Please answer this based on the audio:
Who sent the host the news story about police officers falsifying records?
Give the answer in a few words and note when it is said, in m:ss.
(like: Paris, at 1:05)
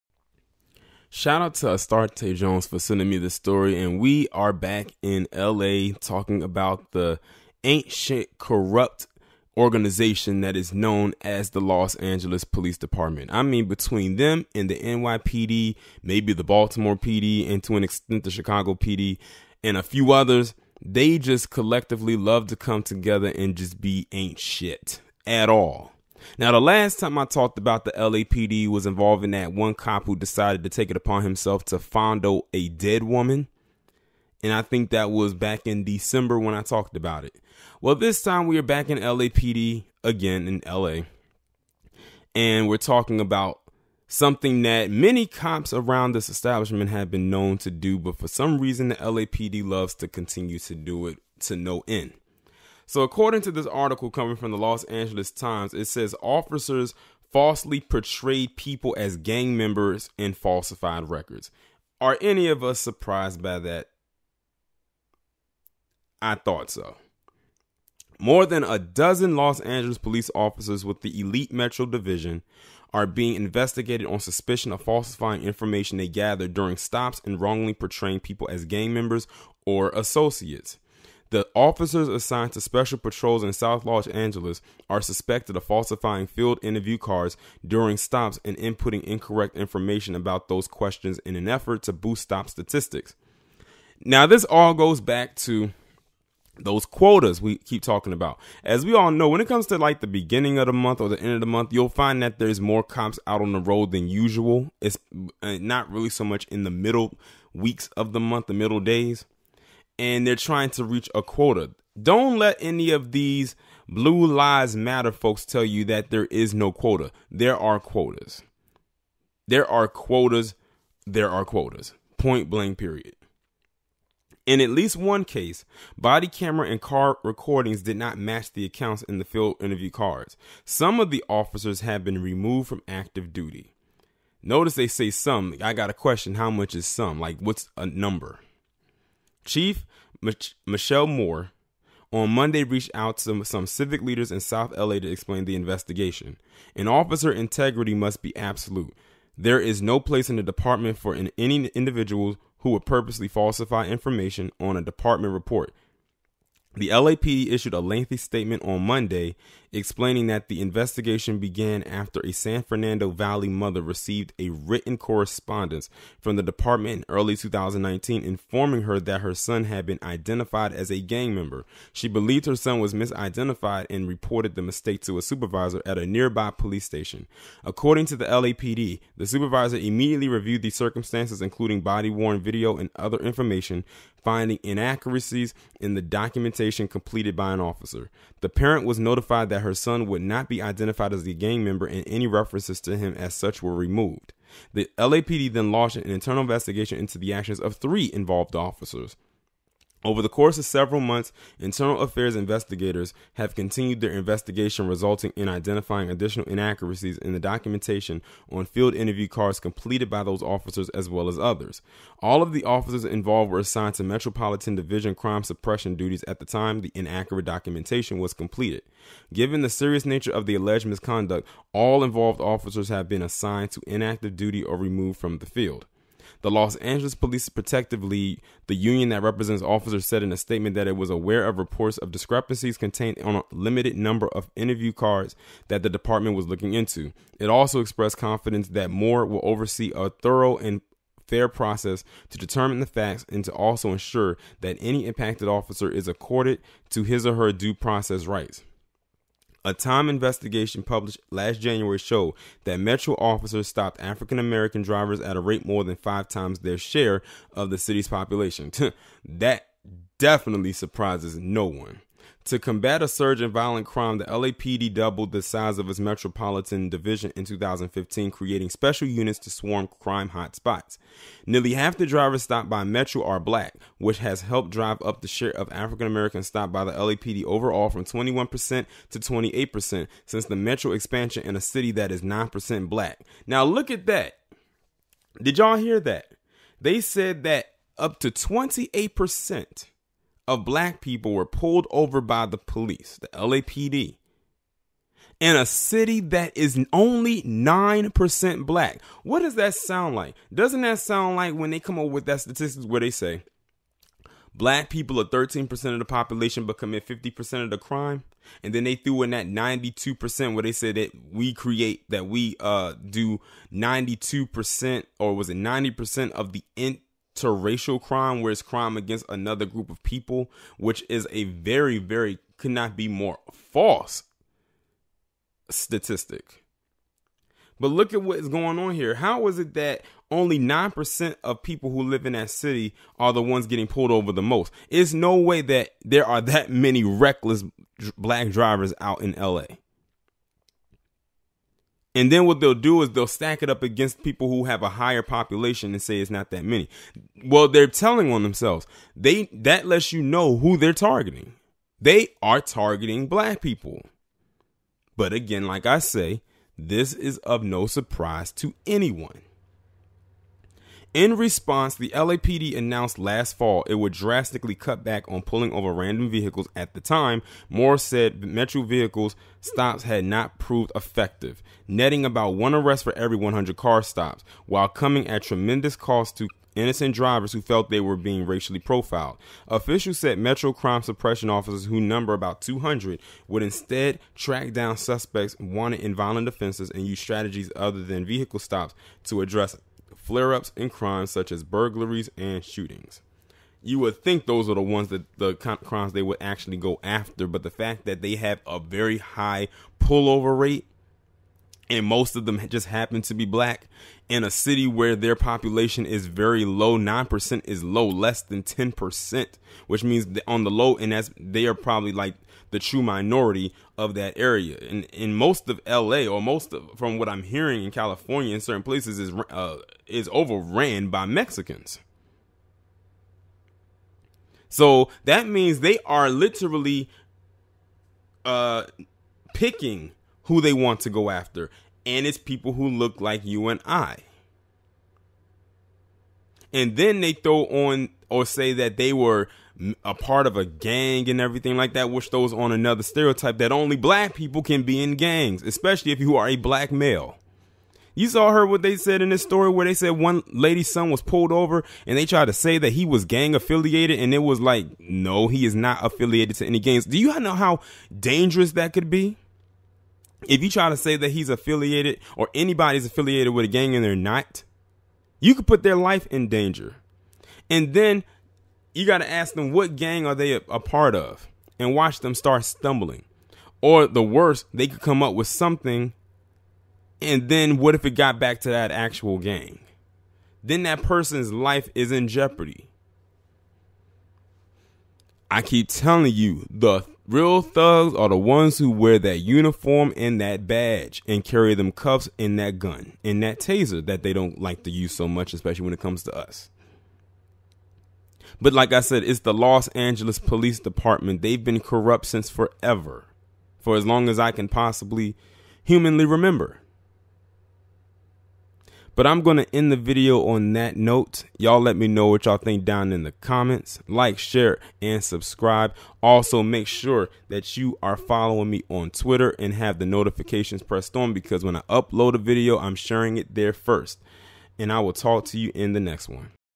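Astarte Jones, at 0:01.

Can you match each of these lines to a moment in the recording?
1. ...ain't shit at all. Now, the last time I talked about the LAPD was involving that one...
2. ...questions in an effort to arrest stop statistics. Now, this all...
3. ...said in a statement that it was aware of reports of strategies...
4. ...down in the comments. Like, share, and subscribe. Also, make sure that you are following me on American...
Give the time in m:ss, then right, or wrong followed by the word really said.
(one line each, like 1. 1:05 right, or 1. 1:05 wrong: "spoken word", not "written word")
1. 0:24 right
2. 1:30 wrong: "boost", not "arrest"
3. 3:50 wrong: "discrepancies", not "strategies"
4. 8:32 wrong: "Twitter", not "American".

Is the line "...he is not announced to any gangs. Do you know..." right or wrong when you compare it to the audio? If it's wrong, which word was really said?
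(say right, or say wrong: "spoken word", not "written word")
wrong: "affiliated", not "announced".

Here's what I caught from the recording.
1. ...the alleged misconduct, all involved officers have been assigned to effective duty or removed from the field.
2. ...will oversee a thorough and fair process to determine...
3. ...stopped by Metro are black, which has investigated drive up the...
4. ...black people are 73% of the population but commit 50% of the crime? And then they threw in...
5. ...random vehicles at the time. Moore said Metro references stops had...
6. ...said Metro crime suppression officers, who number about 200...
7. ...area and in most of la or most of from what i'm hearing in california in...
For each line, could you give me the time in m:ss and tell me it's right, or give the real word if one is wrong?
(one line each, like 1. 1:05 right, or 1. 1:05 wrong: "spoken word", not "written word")
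1. 3:40 wrong: "inactive", not "effective"
2. 3:59 right
3. 4:32 wrong: "helped", not "investigated"
4. 5:04 wrong: "13", not "73"
5. 6:05 wrong: "vehicles", not "references"
6. 6:20 right
7. 6:54 right.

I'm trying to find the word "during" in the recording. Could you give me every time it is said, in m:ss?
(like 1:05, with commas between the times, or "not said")
1:16, 1:27.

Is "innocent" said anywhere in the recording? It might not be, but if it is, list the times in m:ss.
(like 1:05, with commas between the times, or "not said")
6:16.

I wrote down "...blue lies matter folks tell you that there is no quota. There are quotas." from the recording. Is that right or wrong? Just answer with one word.
right.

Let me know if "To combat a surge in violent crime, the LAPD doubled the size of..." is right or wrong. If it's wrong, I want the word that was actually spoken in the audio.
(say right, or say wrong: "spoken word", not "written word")
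right.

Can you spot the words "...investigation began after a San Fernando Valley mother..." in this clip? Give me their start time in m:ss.
2:40.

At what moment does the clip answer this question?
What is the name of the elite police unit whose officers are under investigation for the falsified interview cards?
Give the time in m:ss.
1:11.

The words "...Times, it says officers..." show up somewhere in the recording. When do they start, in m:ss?
0:55.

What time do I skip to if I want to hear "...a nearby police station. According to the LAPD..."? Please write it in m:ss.
2:55.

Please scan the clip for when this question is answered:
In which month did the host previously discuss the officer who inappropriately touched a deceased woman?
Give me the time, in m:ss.
0:35.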